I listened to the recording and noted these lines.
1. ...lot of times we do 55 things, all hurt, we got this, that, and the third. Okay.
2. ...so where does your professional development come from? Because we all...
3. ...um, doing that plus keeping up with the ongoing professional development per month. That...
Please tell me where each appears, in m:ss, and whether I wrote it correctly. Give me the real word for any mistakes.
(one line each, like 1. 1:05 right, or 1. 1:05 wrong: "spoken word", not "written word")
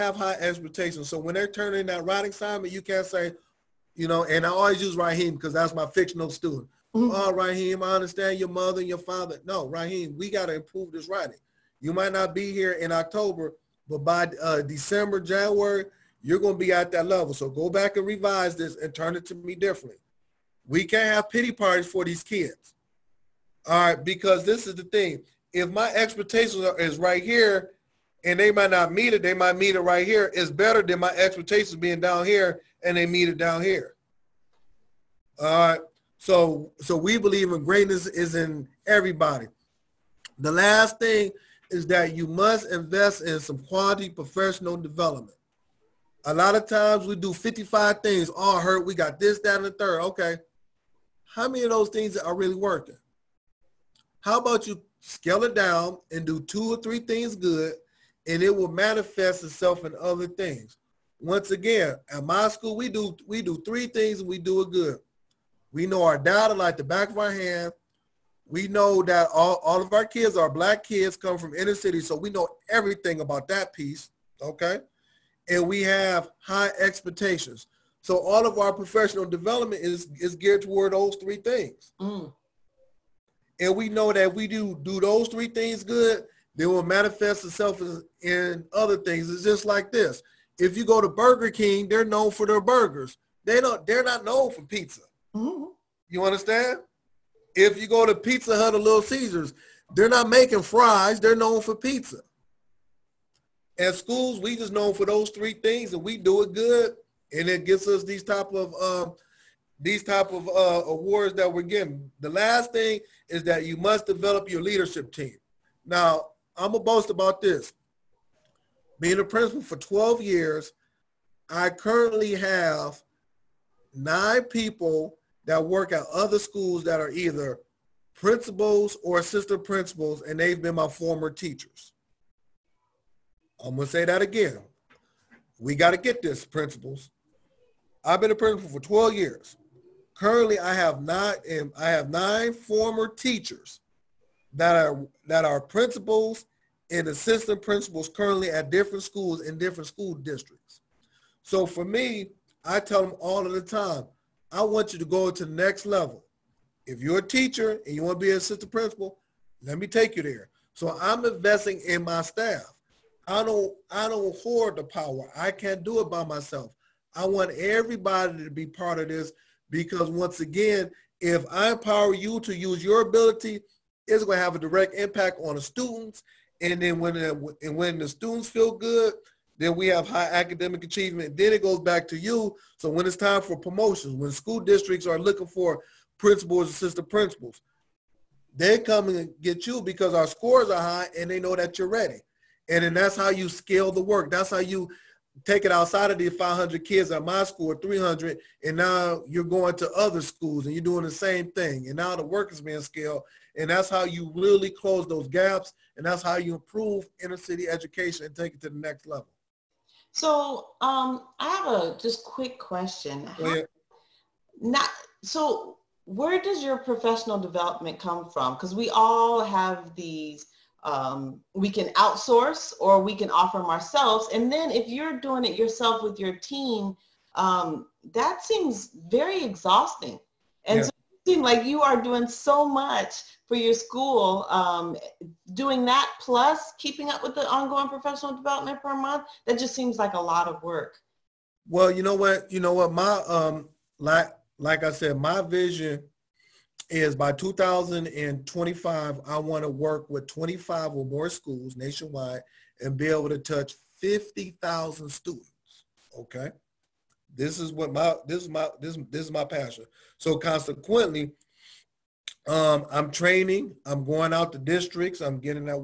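1. 0:46 right
2. 3:35 right
3. 3:54 right.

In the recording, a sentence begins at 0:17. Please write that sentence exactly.
So go back and revise this and turn it to me differently.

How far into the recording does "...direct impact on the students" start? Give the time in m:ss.
2:54.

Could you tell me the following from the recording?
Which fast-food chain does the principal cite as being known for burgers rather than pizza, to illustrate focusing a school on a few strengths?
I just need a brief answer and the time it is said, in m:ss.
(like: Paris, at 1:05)
Burger King, at 1:31.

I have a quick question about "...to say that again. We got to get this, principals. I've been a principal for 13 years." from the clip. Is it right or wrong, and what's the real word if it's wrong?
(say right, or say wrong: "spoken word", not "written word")
wrong: "12", not "13".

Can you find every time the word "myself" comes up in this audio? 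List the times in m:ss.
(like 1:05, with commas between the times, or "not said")
2:46.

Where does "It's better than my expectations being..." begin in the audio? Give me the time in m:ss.
0:30.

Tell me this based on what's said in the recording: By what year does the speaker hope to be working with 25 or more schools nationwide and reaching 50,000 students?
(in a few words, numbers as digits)
2025.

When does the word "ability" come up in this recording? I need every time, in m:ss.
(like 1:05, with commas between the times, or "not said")
2:53.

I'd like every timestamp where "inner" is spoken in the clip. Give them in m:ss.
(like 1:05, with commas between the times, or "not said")
1:11, 3:27.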